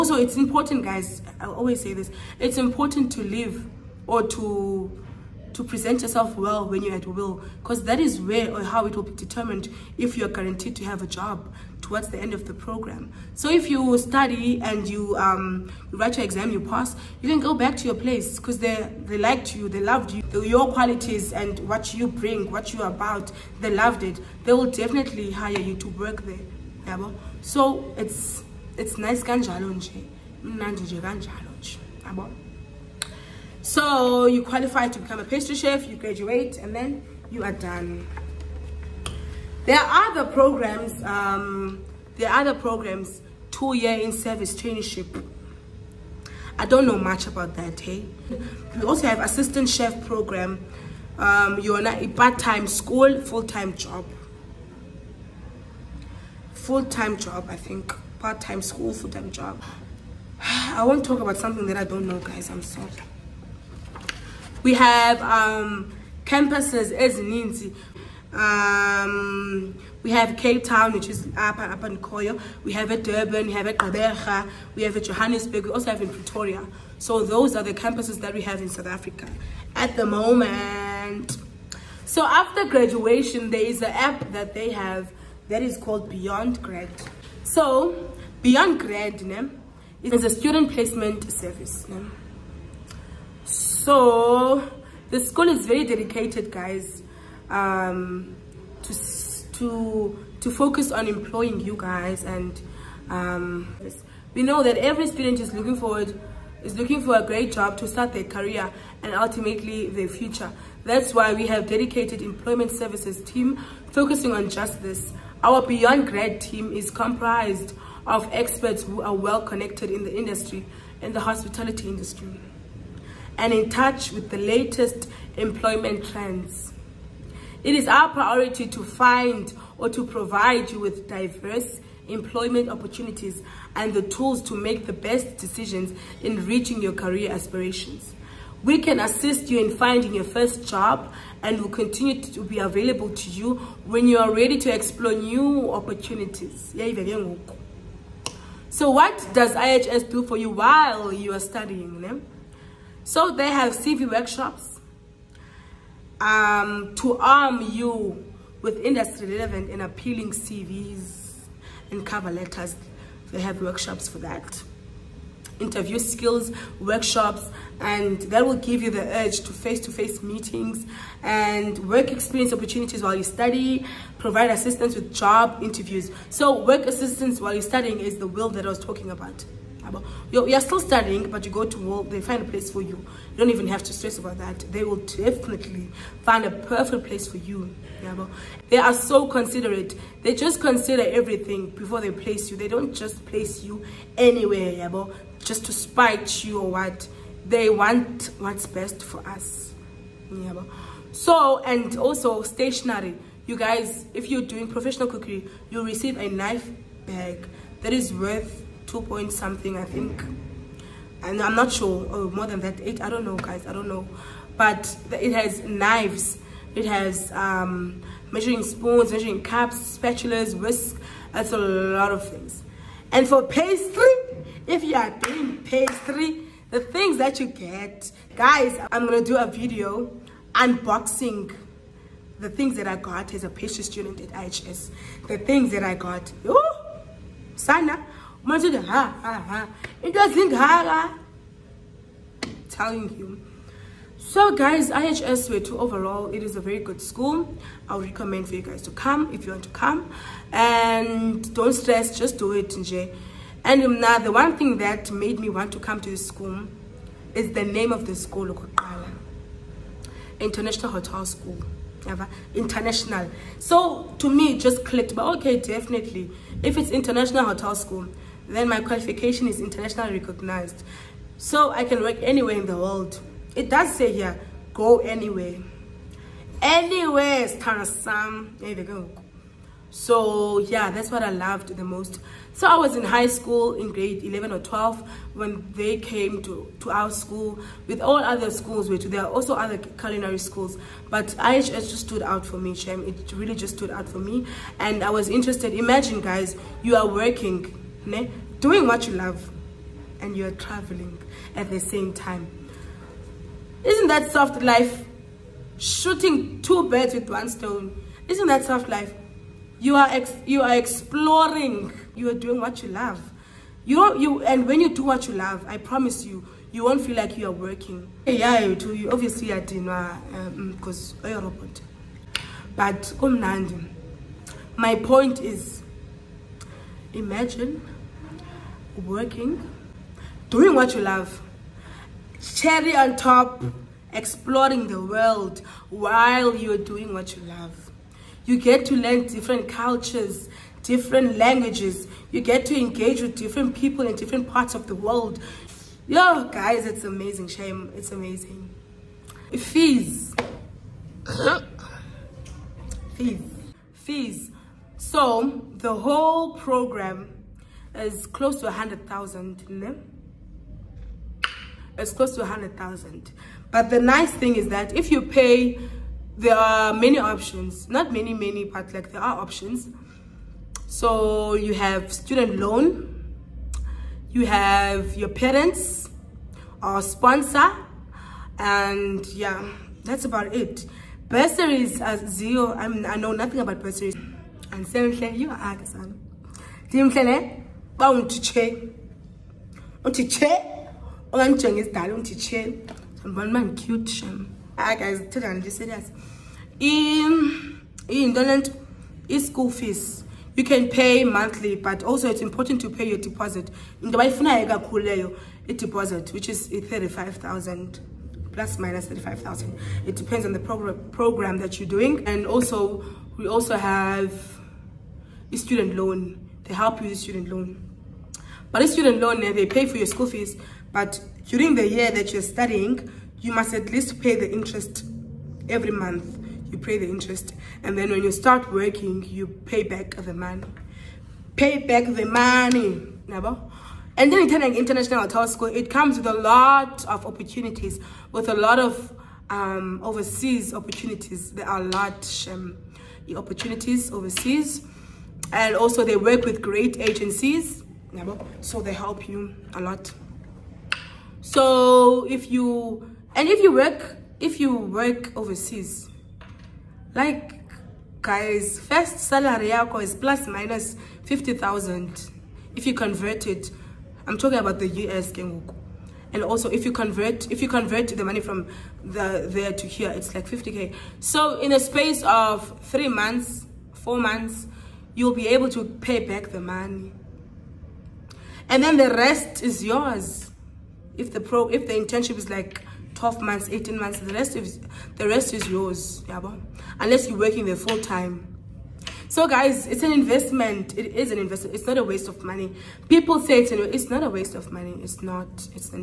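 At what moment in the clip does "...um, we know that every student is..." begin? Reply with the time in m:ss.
1:43.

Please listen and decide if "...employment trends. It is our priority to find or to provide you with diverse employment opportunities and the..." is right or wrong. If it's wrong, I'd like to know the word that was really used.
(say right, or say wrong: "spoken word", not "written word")
right.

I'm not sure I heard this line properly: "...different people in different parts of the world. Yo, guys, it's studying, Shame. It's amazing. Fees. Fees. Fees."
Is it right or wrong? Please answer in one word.
wrong.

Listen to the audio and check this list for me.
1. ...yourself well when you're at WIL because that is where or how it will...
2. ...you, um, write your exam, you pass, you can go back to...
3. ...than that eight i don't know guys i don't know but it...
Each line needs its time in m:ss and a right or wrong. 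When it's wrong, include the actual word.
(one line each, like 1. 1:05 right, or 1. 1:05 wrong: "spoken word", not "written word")
1. 0:06 right
2. 0:14 right
3. 3:32 right.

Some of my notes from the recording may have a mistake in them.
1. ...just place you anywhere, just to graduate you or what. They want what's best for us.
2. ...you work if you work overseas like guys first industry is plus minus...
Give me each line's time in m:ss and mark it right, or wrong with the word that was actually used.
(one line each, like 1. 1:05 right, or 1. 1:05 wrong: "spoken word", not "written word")
1. 3:12 wrong: "spite", not "graduate"
2. 7:33 wrong: "salary", not "industry".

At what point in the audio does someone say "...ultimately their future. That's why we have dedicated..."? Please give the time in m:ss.
1:49.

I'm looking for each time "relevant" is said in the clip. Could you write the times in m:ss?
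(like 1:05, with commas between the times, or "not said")
2:39.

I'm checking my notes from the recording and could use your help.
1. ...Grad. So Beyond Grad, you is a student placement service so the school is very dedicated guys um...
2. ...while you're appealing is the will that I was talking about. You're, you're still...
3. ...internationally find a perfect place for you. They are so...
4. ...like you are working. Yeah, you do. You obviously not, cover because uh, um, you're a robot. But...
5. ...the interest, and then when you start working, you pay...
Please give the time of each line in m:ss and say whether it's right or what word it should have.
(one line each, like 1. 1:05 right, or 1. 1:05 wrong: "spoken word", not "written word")
1. 1:26 right
2. 2:57 wrong: "studying", not "appealing"
3. 3:04 wrong: "definitely", not "internationally"
4. 5:17 wrong: "dinner", not "cover"
5. 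7:06 right.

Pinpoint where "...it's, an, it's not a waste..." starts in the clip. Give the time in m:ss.
8:13.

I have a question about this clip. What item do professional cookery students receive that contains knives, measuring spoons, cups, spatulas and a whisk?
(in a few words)
A knife bag.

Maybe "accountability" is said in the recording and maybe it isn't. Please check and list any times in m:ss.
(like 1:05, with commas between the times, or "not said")
not said.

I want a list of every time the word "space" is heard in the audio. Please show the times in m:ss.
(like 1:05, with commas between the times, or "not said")
7:51.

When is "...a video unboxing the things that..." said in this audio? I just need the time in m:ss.
3:49.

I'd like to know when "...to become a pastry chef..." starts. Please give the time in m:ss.
0:34.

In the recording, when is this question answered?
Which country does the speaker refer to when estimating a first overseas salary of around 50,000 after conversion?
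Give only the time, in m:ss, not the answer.
7:44.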